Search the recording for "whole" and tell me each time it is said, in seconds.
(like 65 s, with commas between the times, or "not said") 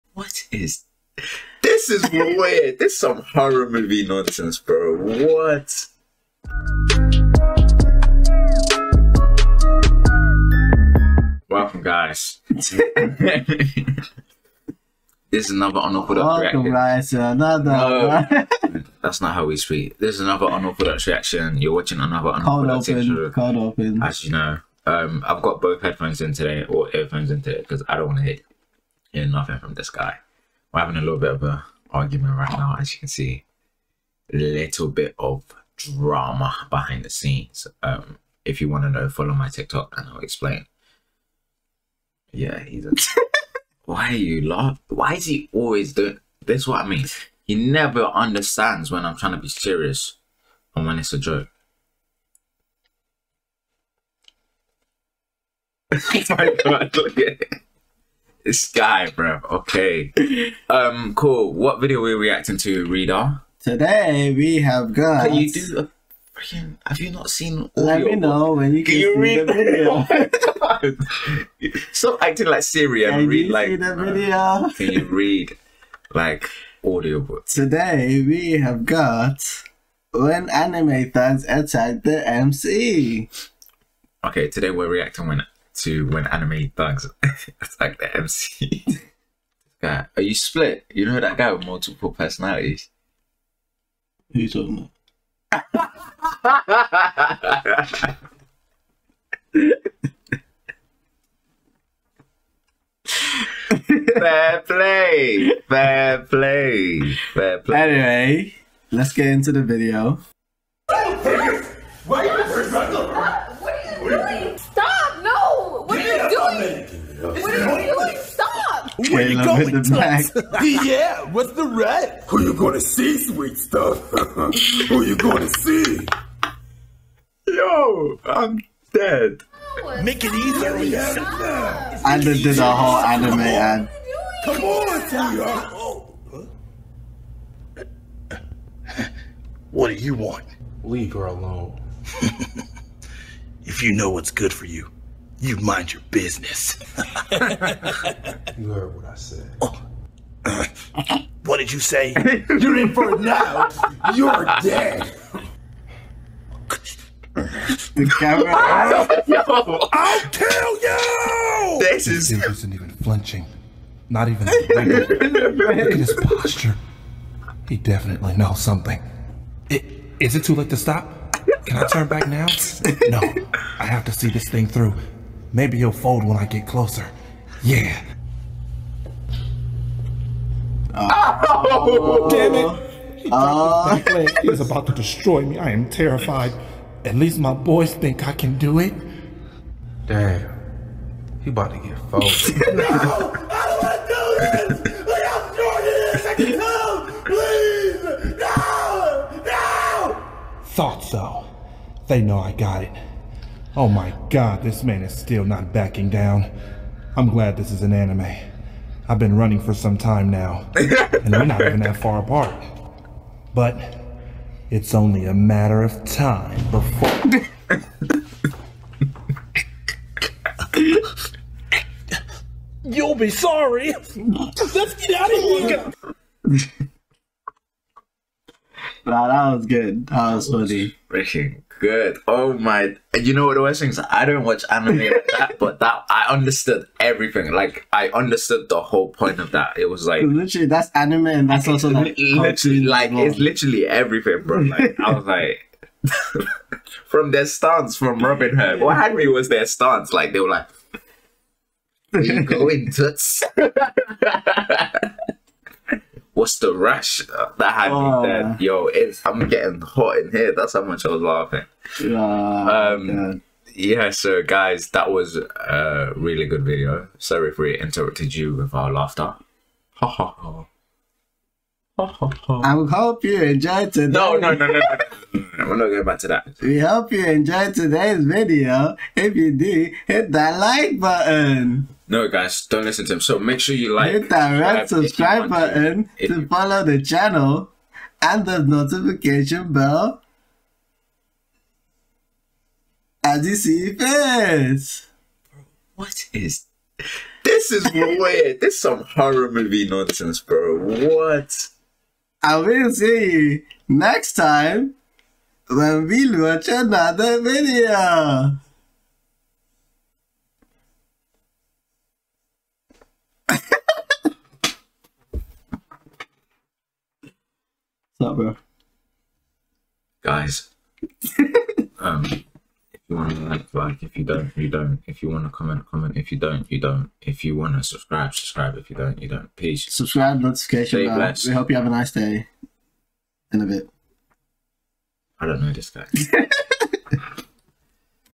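132 s, 238 s.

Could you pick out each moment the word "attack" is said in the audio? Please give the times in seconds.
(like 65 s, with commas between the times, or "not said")
81 s, 87 s.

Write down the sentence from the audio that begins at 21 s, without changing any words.
You're watching another unorthodox reaction open.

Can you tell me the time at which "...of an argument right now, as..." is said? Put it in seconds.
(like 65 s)
31 s.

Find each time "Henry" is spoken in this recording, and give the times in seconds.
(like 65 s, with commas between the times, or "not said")
249 s.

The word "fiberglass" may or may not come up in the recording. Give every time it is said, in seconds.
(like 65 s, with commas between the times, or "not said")
not said.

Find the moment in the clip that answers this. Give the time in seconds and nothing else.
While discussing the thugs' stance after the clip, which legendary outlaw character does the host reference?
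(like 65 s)
248 s.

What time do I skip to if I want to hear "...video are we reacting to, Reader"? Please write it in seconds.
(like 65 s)
61 s.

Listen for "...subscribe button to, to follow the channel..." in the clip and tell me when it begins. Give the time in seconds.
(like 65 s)
284 s.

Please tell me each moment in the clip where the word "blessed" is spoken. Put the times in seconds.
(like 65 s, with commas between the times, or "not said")
331 s.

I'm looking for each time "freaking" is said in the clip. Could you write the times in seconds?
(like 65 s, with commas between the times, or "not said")
66 s, 231 s.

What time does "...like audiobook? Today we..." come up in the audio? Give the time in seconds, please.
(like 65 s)
76 s.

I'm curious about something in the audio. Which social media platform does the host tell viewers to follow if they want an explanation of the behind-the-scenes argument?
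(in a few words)
TikTok.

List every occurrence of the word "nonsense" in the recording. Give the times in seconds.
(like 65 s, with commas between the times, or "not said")
4 s, 299 s.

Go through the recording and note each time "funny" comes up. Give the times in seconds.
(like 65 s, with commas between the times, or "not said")
230 s.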